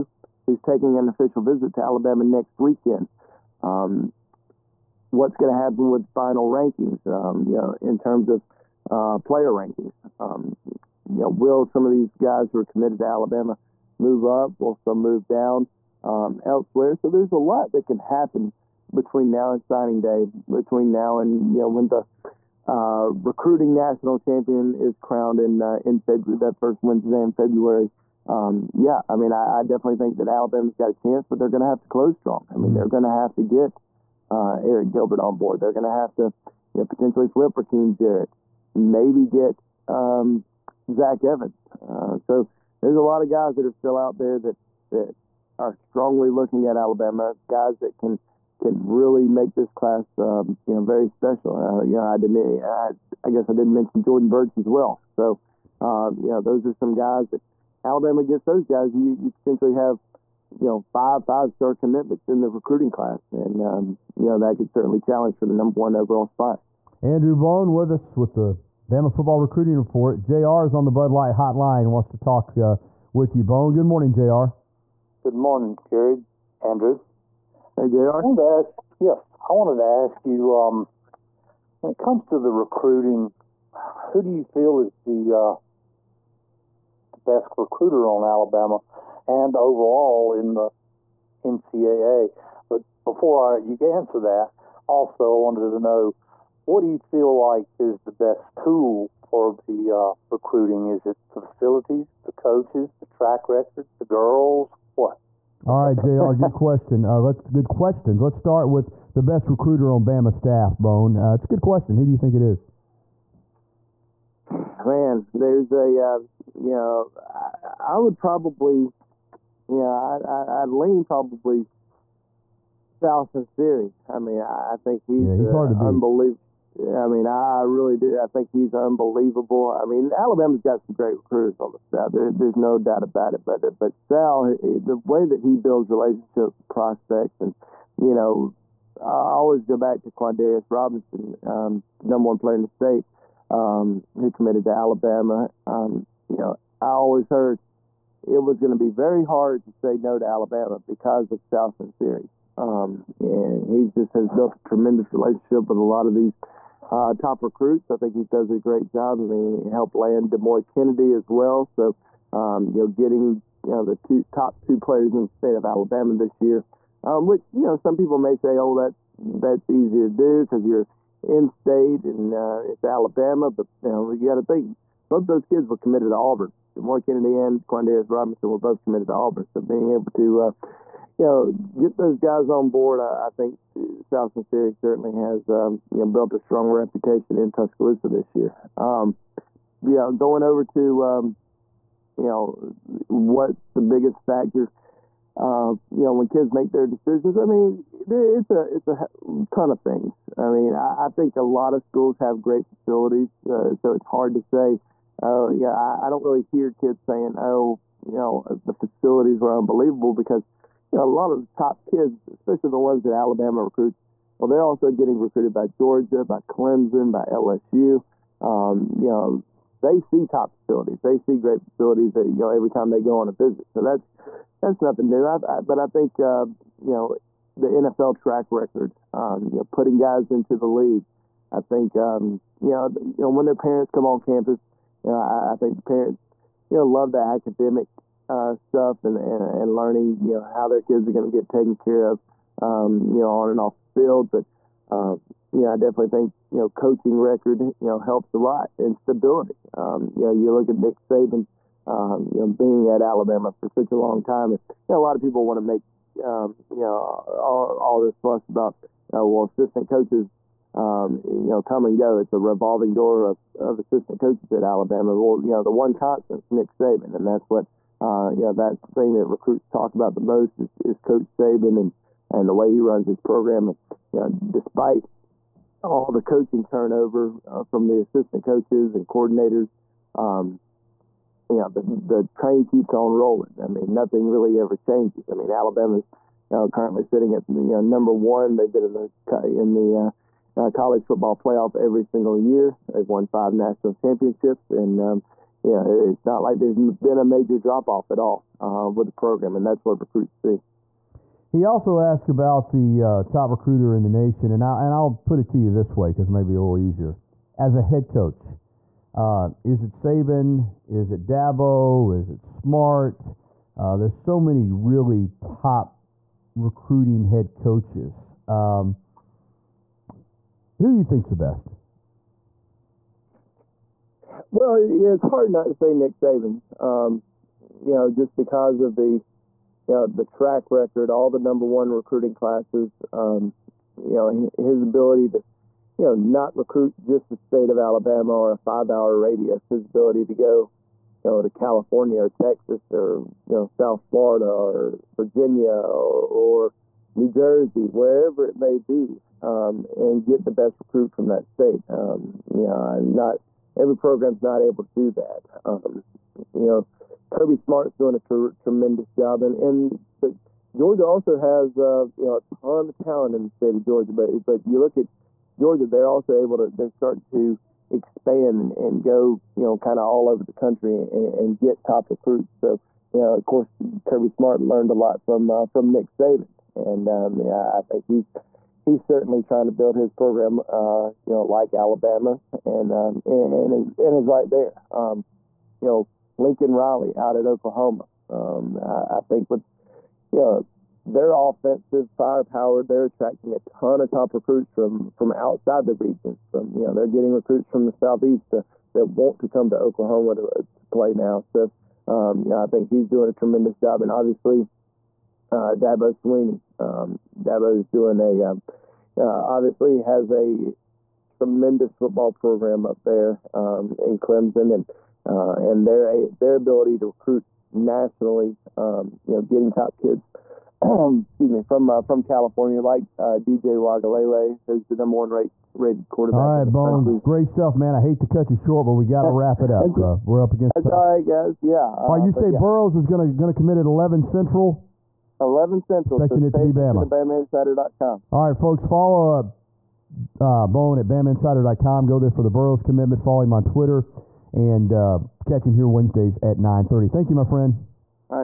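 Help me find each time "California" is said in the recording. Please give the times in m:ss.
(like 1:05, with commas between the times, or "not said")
5:41, 7:02.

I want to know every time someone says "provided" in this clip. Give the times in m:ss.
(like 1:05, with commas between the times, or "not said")
not said.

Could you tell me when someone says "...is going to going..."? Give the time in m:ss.
7:12.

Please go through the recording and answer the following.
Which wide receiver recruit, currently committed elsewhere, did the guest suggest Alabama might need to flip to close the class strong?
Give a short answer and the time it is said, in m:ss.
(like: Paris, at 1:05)
Rakim Jarrett, at 0:37.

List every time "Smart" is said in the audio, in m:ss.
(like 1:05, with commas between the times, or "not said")
5:12, 5:57, 6:14.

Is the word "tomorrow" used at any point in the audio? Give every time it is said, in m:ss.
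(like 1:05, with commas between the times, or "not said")
not said.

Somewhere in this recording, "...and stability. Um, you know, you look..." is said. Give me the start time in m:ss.
4:08.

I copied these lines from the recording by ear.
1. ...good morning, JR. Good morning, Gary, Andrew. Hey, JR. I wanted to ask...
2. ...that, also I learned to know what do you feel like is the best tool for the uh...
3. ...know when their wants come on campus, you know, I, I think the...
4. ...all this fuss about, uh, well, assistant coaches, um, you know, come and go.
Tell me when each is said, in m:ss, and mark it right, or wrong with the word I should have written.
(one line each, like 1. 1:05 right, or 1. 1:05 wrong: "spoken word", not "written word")
1. 1:13 right
2. 1:34 wrong: "wanted", not "learned"
3. 3:53 wrong: "parents", not "wants"
4. 4:17 right.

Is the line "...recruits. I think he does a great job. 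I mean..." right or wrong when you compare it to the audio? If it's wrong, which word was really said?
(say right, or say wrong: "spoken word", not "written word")
right.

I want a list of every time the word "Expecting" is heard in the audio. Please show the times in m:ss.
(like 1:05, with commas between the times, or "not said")
7:16.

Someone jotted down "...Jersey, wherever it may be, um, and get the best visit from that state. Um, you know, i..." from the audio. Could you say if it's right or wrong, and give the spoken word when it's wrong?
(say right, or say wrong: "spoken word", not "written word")
wrong: "recruit", not "visit".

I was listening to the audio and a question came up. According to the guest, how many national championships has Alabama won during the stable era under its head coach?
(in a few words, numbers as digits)
5.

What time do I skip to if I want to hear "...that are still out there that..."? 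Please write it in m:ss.
0:43.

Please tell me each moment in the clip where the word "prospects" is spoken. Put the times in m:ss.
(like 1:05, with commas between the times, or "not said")
2:16.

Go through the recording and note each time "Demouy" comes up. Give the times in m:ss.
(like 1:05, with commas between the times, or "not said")
2:40, 2:56.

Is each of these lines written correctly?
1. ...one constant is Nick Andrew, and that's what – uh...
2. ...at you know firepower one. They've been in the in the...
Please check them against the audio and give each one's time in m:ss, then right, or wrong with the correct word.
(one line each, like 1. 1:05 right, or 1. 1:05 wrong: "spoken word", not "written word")
1. 4:25 wrong: "Saban", not "Andrew"
2. 4:47 wrong: "number", not "firepower".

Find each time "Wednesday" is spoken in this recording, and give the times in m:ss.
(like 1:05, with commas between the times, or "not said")
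0:26, 7:25.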